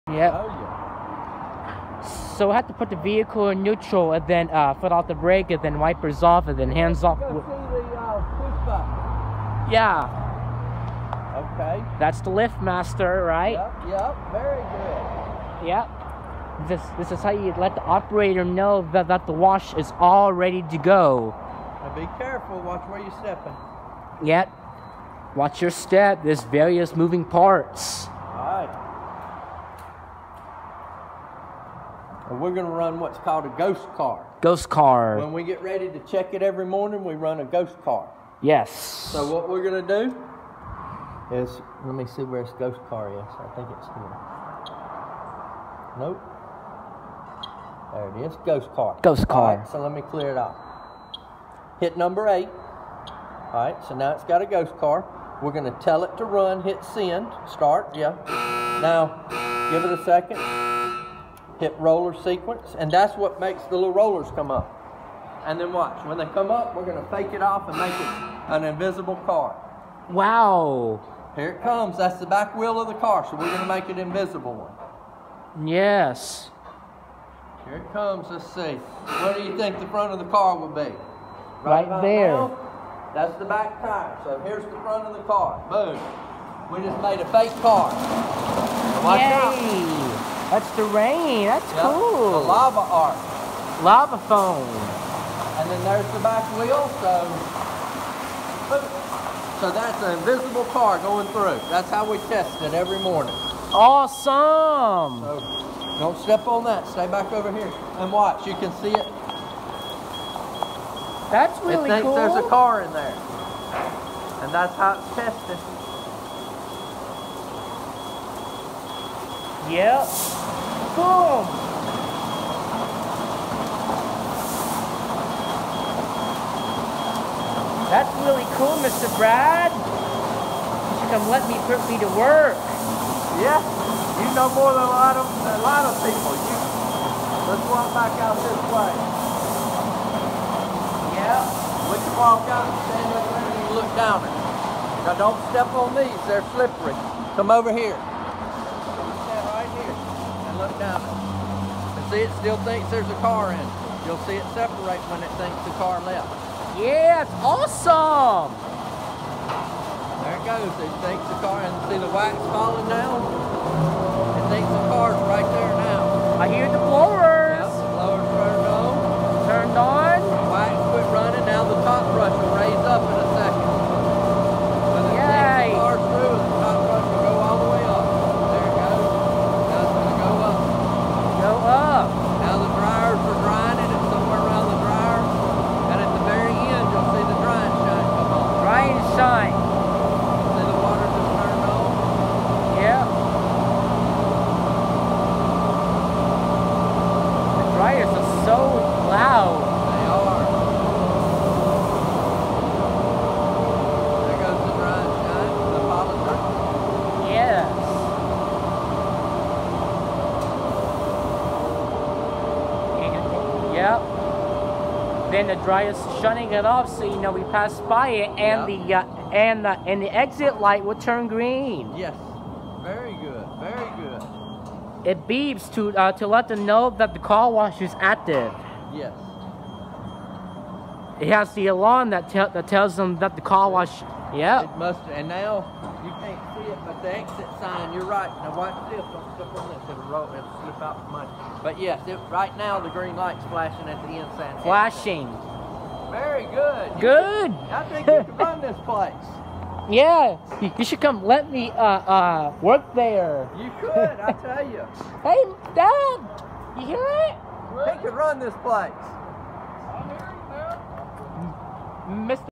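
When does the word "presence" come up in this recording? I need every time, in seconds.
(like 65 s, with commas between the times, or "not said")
not said.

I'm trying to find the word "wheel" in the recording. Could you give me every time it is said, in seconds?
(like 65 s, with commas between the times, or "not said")
72 s, 96 s.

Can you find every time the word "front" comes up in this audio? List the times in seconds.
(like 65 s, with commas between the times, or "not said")
79 s, 84 s.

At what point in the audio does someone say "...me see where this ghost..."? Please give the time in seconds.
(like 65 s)
41 s.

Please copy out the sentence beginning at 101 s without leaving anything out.
That's how we test it every morning.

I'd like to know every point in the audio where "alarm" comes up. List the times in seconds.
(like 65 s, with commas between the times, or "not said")
231 s.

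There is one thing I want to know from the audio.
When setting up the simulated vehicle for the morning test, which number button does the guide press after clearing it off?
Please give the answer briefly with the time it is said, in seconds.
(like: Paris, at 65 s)
8, at 52 s.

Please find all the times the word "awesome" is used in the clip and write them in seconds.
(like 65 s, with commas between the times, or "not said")
103 s, 157 s.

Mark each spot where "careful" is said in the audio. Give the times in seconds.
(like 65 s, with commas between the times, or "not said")
22 s.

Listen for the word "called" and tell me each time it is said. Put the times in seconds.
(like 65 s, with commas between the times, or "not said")
33 s.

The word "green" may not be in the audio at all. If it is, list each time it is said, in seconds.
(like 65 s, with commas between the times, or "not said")
221 s, 242 s.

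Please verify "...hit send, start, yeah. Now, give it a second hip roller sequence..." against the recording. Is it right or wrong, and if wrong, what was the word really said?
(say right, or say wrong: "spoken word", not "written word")
right.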